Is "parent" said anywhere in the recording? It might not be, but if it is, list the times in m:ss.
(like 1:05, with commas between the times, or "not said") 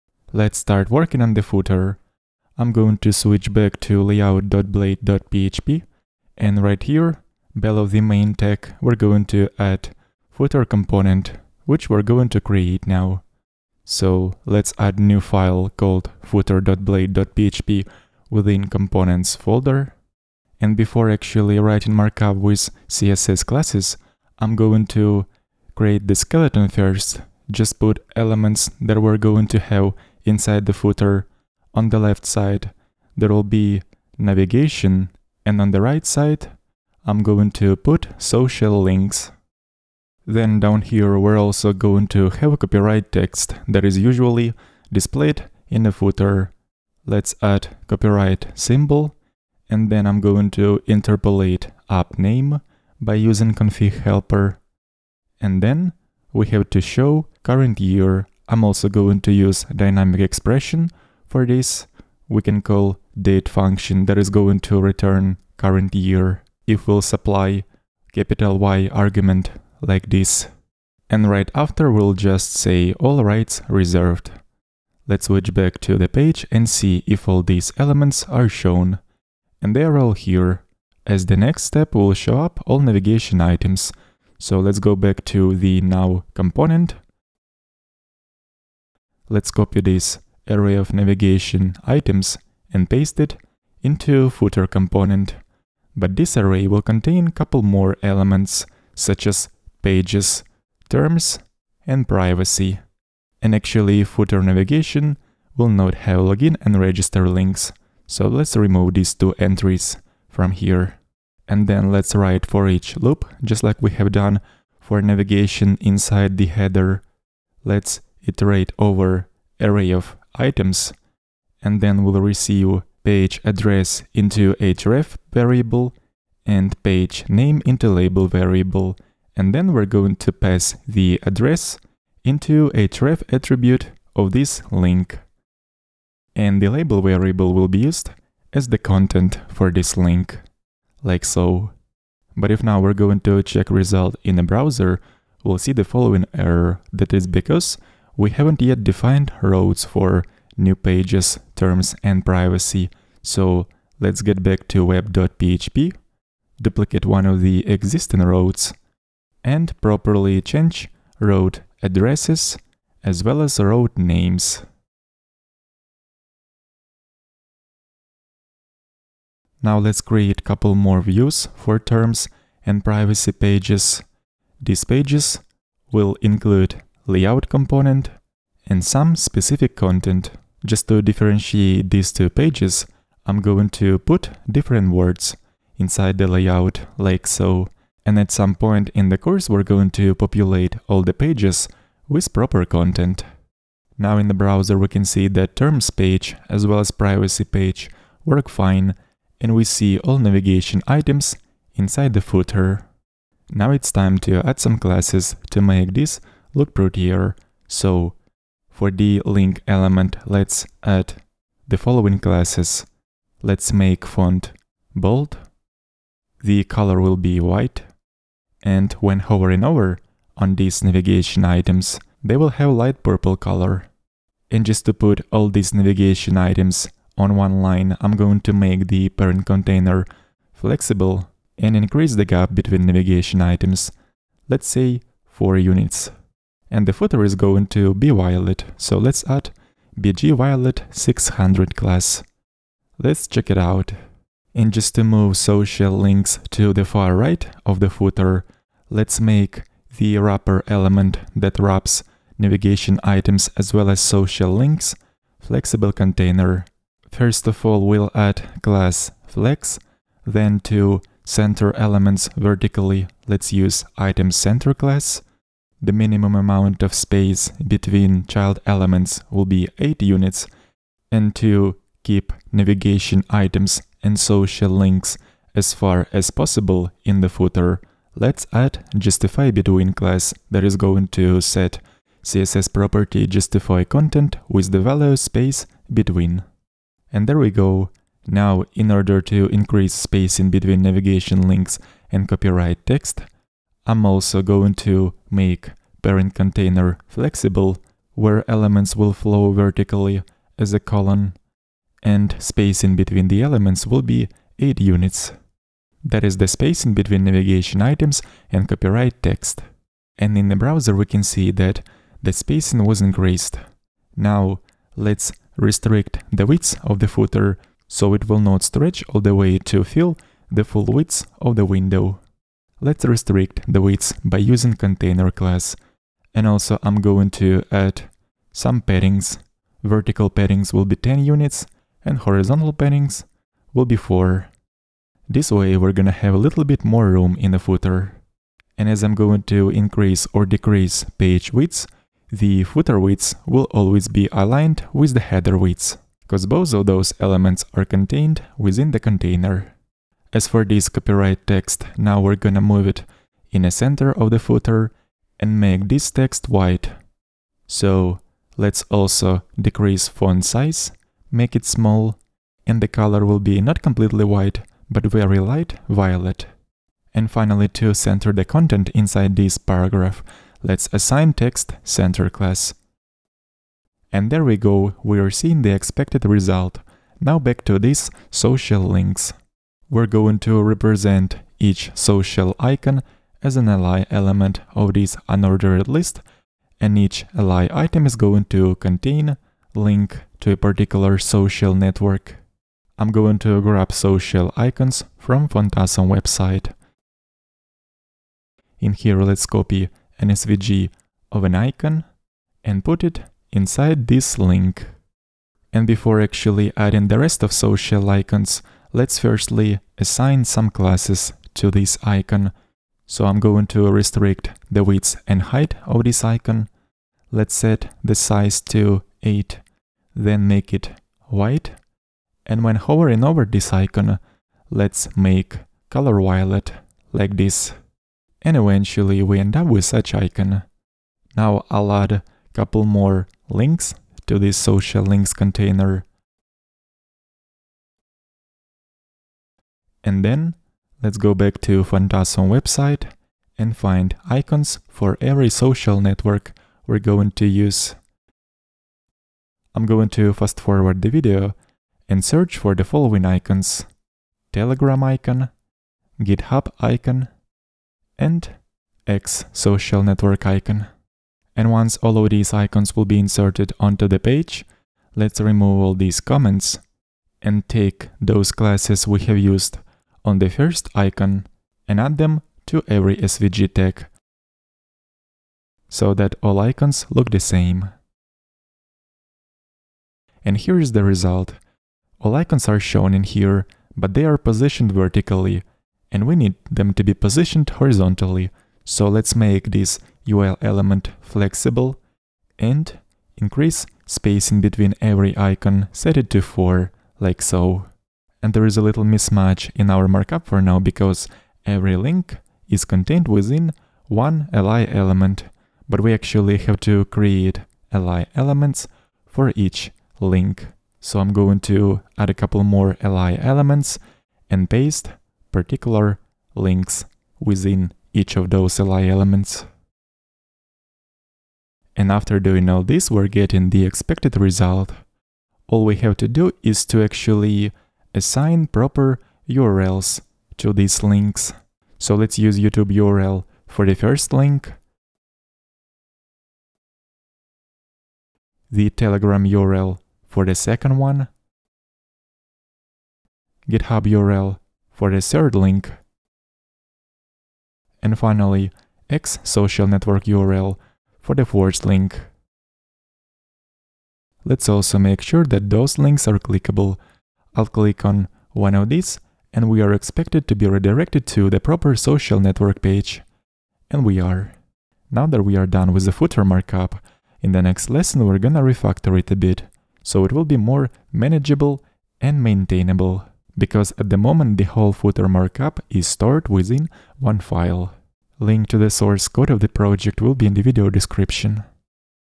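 3:49, 4:56.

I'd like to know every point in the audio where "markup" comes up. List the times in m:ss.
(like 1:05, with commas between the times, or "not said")
0:21, 8:20, 9:26, 9:35.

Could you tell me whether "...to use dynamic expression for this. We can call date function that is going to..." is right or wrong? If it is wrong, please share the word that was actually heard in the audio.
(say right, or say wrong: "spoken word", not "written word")
right.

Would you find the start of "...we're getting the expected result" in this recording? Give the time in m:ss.
8:43.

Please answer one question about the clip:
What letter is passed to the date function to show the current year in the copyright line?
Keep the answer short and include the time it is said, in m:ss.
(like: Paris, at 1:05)
Capital Y, at 1:08.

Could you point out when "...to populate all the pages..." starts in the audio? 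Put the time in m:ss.
3:09.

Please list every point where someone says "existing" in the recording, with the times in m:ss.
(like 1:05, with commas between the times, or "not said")
2:37.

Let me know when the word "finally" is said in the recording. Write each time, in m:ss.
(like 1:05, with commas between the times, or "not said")
6:07, 9:08.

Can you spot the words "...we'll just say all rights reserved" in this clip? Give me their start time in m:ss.
1:11.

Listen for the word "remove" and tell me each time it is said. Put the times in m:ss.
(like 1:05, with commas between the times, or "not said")
1:48, 7:45.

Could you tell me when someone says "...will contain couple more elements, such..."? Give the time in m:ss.
1:36.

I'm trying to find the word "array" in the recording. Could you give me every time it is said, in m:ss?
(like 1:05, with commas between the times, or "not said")
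1:30, 1:36, 1:59.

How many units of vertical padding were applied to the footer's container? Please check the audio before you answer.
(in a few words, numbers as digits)
10.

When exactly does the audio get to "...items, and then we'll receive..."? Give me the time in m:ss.
2:00.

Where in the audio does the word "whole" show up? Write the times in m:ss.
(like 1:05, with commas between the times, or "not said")
9:34.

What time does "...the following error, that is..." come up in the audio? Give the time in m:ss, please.
2:25.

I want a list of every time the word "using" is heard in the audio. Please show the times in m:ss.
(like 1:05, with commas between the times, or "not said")
0:53, 5:24.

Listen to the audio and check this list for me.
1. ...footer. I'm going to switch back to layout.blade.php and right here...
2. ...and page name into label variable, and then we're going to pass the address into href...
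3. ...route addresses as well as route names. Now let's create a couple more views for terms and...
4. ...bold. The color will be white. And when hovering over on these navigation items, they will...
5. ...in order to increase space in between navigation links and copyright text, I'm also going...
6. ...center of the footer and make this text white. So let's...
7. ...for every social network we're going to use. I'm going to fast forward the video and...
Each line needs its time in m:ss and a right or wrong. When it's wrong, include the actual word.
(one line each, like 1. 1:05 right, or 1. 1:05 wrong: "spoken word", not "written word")
1. 0:01 right
2. 2:06 right
3. 2:41 right
4. 3:34 right
5. 4:48 right
6. 5:53 right
7. 7:24 right.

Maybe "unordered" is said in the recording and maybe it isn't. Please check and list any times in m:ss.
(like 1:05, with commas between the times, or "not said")
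6:25.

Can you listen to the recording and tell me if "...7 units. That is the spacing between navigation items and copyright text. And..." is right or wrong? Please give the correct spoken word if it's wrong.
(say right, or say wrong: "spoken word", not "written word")
wrong: "8", not "7".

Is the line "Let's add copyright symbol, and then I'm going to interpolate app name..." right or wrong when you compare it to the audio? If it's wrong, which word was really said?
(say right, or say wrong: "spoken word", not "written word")
right.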